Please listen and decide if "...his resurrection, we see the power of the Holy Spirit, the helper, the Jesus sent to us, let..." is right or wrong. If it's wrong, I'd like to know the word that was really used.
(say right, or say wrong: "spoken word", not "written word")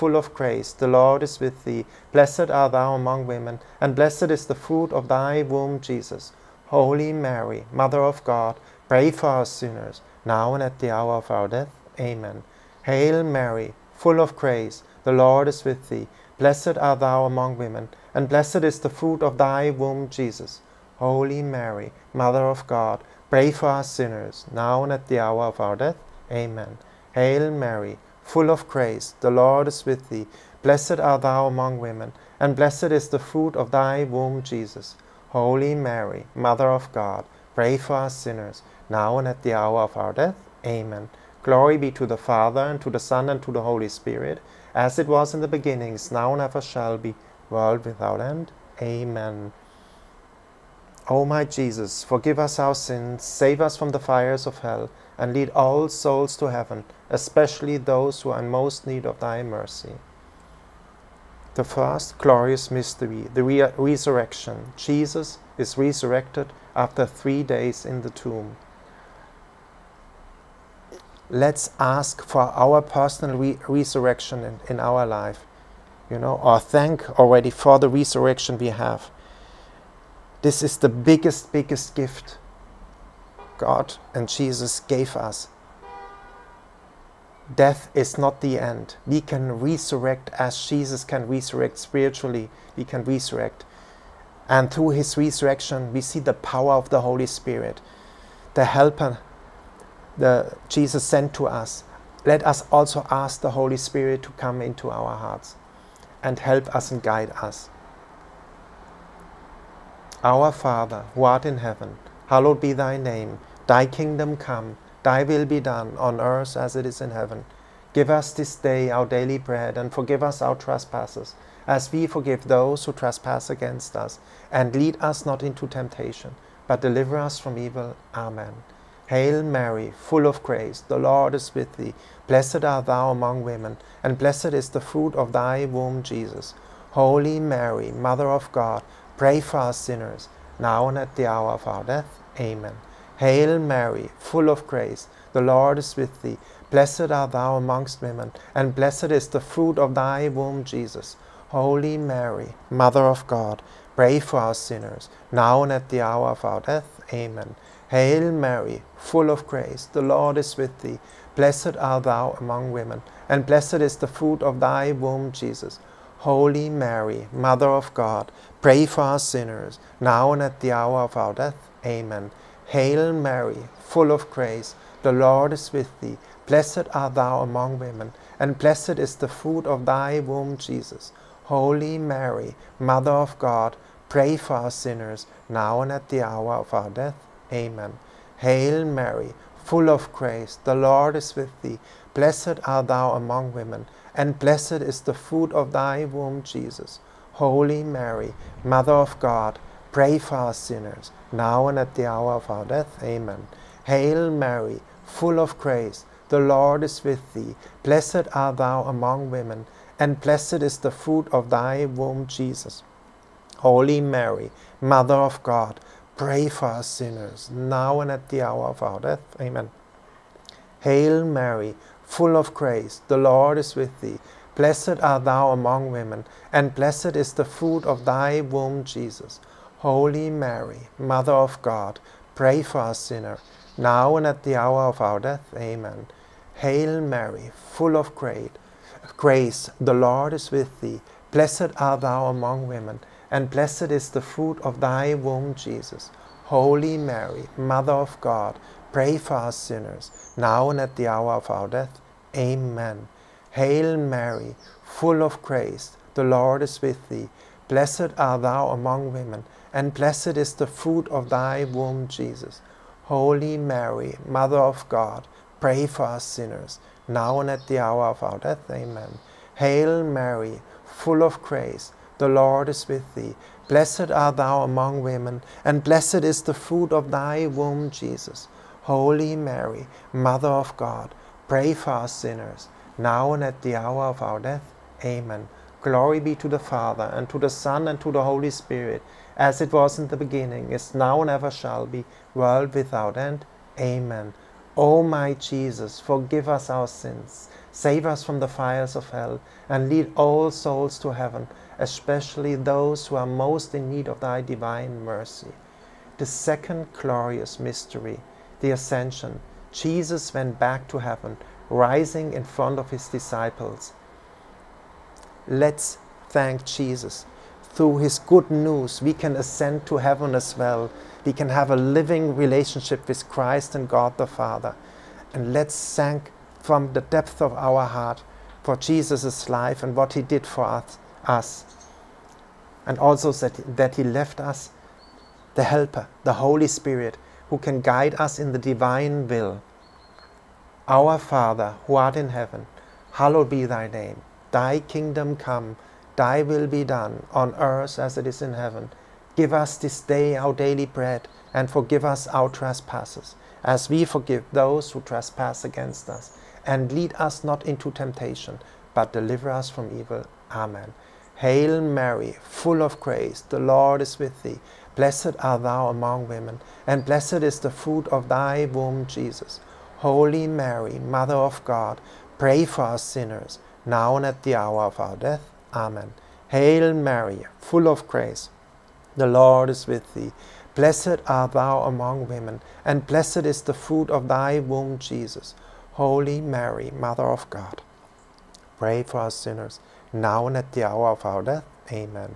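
right.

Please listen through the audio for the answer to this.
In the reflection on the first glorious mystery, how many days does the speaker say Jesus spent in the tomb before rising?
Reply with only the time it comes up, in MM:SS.
01:07.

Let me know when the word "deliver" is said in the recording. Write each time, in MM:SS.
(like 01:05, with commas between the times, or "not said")
02:06, 05:59.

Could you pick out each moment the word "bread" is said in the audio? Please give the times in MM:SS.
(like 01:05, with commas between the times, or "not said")
01:59, 05:50.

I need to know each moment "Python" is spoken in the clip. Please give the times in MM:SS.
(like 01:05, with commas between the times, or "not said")
not said.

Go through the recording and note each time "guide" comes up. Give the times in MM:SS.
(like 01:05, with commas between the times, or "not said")
01:47, 05:37.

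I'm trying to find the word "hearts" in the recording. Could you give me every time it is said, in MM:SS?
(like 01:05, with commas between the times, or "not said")
01:45, 05:27.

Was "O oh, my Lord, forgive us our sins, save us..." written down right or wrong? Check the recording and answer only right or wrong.
wrong.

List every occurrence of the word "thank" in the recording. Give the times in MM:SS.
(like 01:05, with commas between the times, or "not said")
01:16, 05:16, 05:25.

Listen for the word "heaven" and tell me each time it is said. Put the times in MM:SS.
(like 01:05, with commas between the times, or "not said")
00:56, 01:51, 01:57, 05:01, 05:10, 05:19, 05:42, 05:48.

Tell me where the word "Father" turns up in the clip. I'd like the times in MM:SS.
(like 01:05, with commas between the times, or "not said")
00:42, 01:50, 04:46, 05:24, 05:41.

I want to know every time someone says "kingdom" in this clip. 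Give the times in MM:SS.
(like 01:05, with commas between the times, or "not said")
01:53, 05:44.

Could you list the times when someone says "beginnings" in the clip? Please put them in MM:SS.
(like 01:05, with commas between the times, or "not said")
00:45, 04:50.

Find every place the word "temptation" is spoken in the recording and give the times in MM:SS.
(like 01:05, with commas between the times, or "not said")
02:05, 05:57.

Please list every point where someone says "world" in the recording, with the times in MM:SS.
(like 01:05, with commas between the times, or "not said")
00:47, 04:52.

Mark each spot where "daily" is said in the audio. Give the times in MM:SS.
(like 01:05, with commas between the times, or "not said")
01:59, 05:50.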